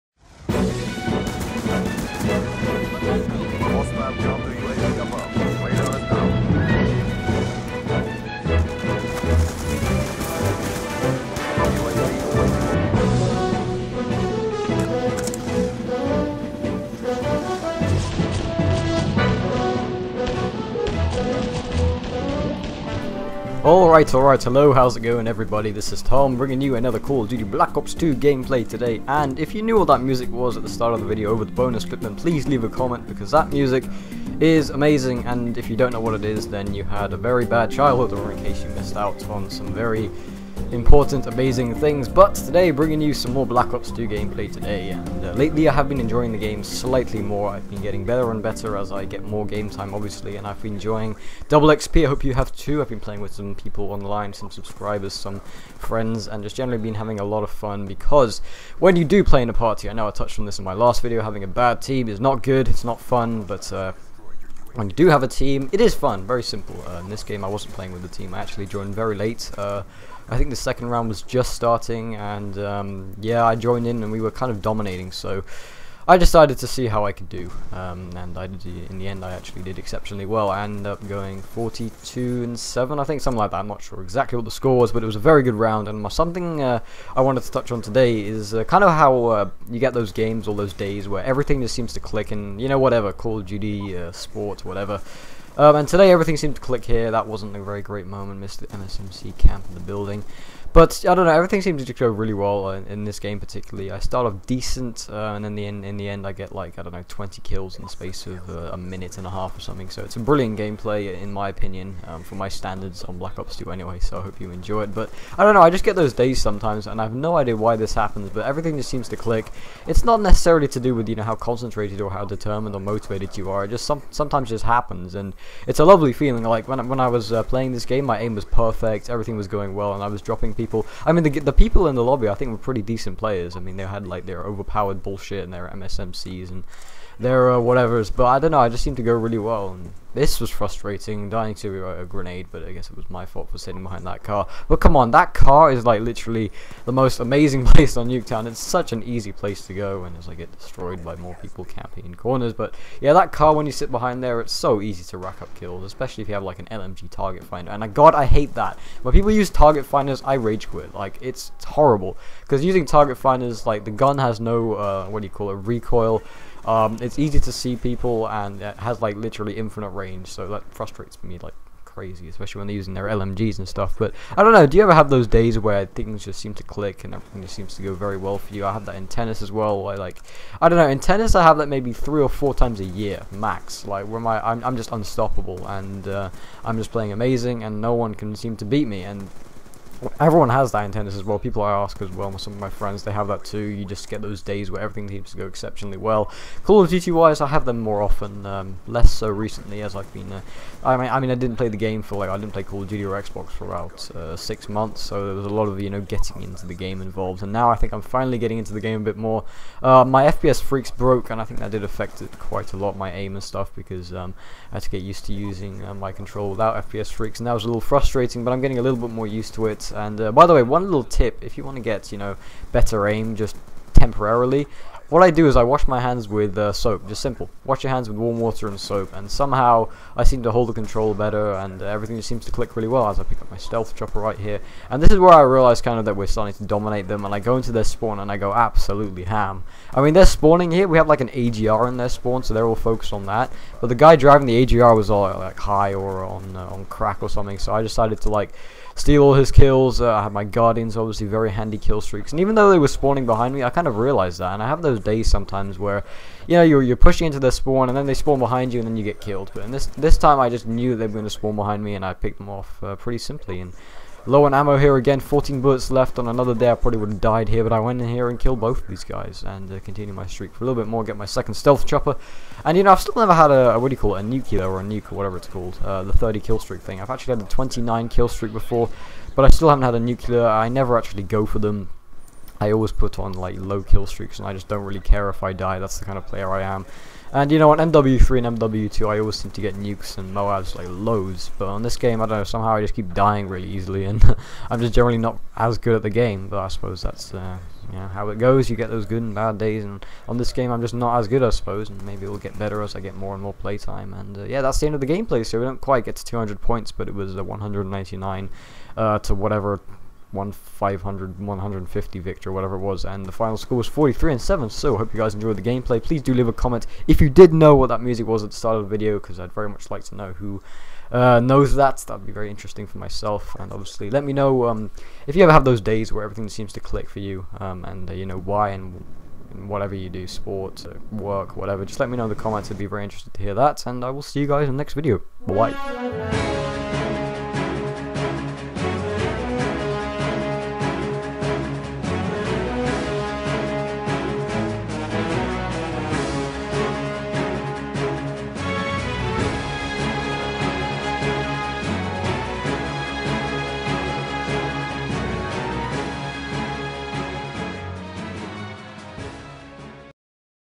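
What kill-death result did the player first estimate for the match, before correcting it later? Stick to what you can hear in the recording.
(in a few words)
42 and 7.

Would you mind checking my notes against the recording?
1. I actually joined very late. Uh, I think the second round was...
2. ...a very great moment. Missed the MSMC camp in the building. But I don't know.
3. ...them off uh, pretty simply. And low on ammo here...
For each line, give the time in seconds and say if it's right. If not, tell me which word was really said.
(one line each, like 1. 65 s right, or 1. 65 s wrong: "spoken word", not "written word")
1. 68 s right
2. 97 s right
3. 262 s right.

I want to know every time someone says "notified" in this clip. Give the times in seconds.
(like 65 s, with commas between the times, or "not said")
not said.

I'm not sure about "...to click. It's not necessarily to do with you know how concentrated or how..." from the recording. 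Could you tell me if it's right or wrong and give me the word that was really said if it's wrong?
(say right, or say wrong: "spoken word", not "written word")
right.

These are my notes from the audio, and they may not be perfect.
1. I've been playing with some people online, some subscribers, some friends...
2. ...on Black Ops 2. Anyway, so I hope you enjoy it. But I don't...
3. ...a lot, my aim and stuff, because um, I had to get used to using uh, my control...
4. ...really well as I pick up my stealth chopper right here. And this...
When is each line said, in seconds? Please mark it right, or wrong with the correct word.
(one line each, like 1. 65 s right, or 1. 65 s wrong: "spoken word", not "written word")
1. 52 s right
2. 113 s right
3. 212 s right
4. 232 s right.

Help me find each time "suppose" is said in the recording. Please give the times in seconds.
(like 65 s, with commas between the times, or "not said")
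296 s, 301 s.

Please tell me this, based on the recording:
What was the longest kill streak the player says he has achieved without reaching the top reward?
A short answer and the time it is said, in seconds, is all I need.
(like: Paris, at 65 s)
29, at 277 s.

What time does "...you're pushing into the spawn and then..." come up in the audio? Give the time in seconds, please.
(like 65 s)
256 s.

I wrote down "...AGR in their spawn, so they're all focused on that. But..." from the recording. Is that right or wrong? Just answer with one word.
right.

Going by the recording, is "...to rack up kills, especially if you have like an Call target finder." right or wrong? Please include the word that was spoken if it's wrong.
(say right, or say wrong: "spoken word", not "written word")
wrong: "LMG", not "Call".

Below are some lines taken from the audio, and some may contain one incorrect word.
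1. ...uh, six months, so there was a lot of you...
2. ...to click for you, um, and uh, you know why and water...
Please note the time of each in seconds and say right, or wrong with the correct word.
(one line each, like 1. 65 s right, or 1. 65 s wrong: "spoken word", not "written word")
1. 204 s right
2. 326 s wrong: "whatever", not "water".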